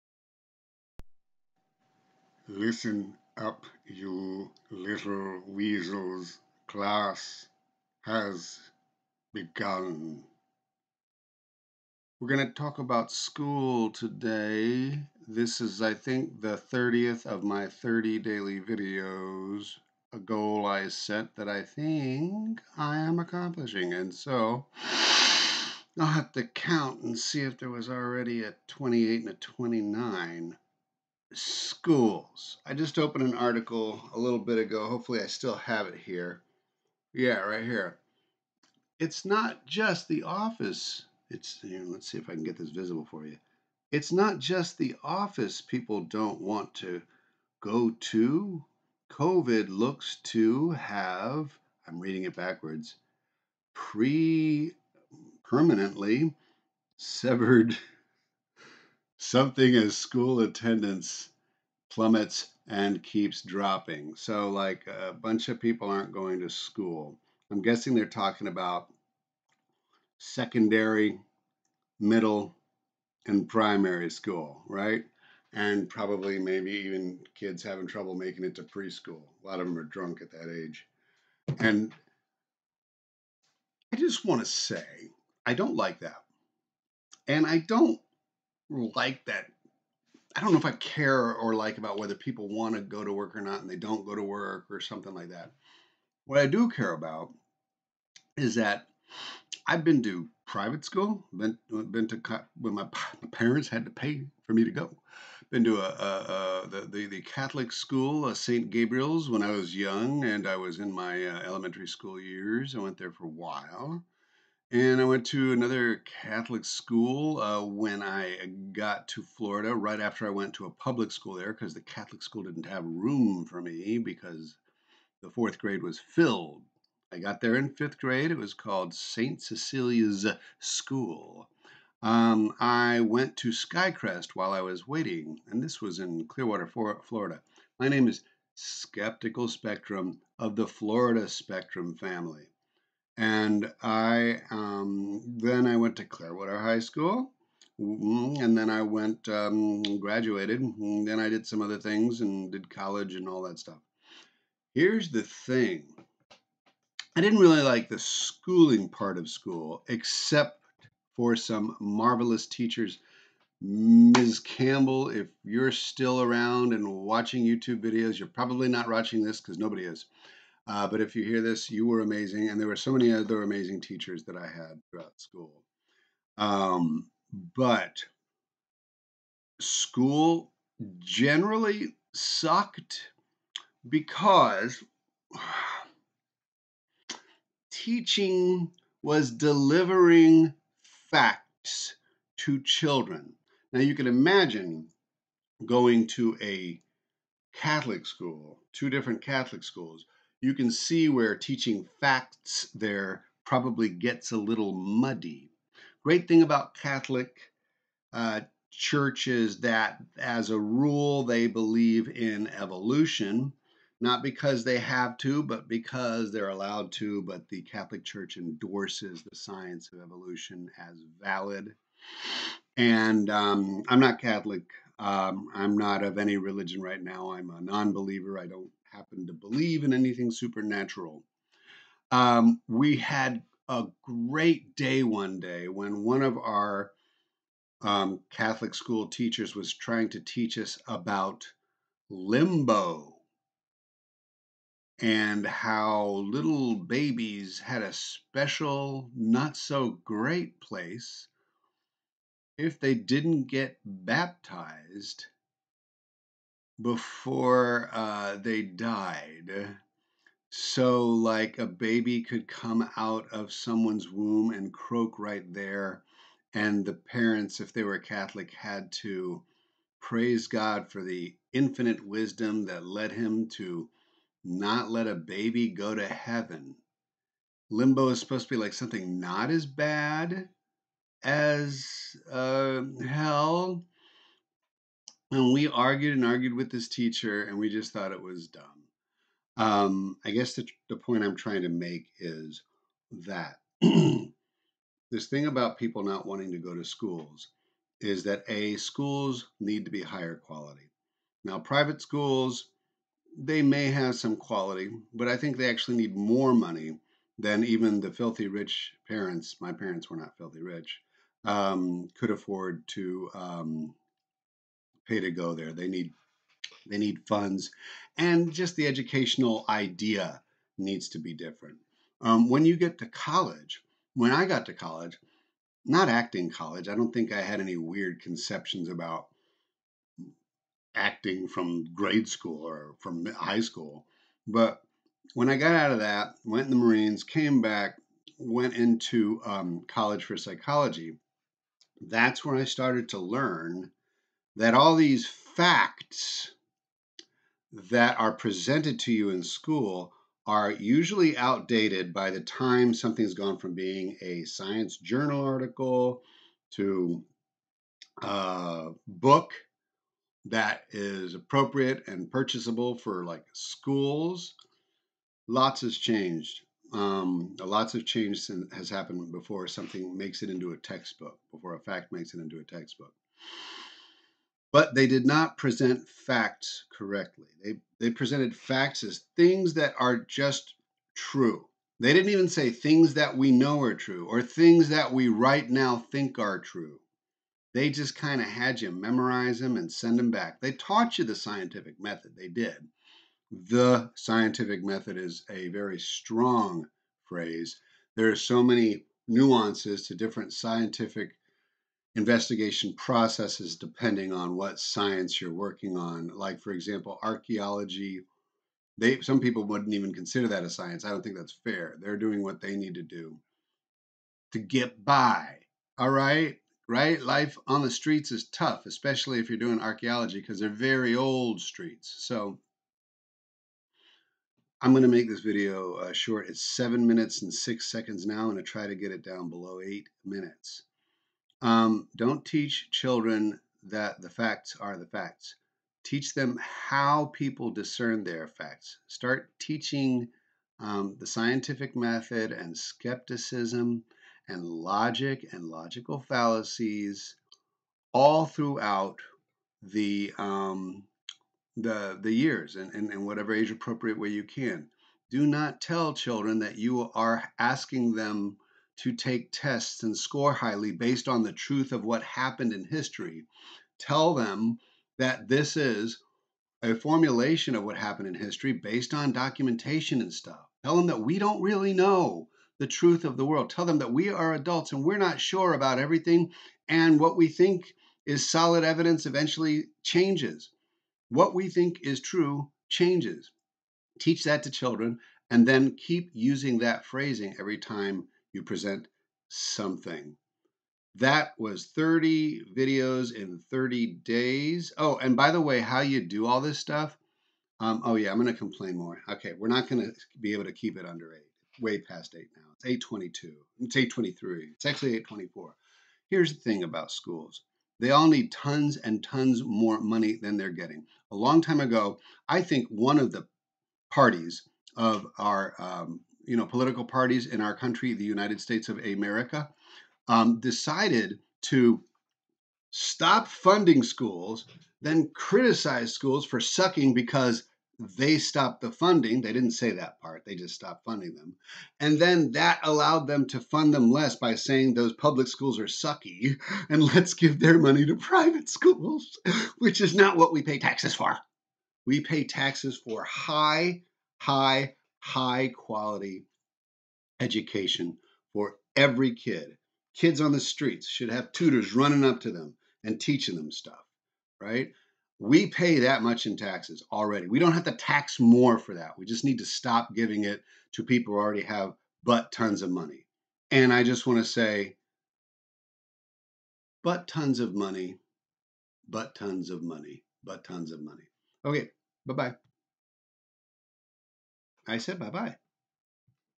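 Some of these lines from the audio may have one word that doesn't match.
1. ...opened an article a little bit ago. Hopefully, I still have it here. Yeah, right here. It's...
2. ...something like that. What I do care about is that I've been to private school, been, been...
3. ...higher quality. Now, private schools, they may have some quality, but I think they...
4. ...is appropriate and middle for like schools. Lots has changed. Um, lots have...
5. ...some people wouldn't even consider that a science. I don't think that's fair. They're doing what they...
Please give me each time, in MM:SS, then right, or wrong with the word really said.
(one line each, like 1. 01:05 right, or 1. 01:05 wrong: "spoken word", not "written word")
1. 00:32 right
2. 01:34 right
3. 05:00 right
4. 06:00 wrong: "purchasable", not "middle"
5. 06:49 right.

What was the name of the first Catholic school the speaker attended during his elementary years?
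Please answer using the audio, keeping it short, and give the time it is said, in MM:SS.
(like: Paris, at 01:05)
St. Gabriel's, at 01:48.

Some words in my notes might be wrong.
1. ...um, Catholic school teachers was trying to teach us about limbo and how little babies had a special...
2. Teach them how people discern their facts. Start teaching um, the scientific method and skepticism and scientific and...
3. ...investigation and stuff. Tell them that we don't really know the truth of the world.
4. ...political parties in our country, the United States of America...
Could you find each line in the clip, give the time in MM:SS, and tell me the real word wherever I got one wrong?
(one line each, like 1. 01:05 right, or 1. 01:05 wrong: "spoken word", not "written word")
1. 03:57 right
2. 07:16 wrong: "logic", not "scientific"
3. 07:49 wrong: "documentation", not "investigation"
4. 08:36 right.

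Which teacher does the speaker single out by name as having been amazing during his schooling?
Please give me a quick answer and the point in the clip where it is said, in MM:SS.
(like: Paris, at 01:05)
Ms. Campbell, at 02:43.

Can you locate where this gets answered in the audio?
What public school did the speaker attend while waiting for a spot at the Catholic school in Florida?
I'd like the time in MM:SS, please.
02:13.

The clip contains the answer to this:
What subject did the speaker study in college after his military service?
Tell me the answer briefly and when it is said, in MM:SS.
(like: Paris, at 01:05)
psychology, at 05:40.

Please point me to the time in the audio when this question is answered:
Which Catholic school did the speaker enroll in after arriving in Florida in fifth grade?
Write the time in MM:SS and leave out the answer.
02:08.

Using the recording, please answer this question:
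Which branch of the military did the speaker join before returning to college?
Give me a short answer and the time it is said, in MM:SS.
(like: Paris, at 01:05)
the Marines, at 05:36.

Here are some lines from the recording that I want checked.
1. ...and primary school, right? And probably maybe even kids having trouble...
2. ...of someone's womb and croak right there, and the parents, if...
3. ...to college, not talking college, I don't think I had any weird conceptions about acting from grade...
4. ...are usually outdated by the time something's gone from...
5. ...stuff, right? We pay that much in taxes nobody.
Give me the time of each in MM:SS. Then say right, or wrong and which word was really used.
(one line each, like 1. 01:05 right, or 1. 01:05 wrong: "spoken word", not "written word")
1. 01:13 right
2. 04:23 right
3. 05:24 wrong: "acting", not "talking"
4. 05:50 right
5. 09:13 wrong: "already", not "nobody".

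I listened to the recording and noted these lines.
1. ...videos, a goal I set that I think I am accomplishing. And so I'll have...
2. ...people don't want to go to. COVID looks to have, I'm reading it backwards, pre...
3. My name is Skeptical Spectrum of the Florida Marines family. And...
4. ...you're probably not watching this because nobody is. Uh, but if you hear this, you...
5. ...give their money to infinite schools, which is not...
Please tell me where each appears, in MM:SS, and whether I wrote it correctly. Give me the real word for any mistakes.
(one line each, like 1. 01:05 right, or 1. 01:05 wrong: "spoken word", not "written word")
1. 00:18 right
2. 00:45 right
3. 02:17 wrong: "Spectrum", not "Marines"
4. 02:48 right
5. 08:57 wrong: "private", not "infinite".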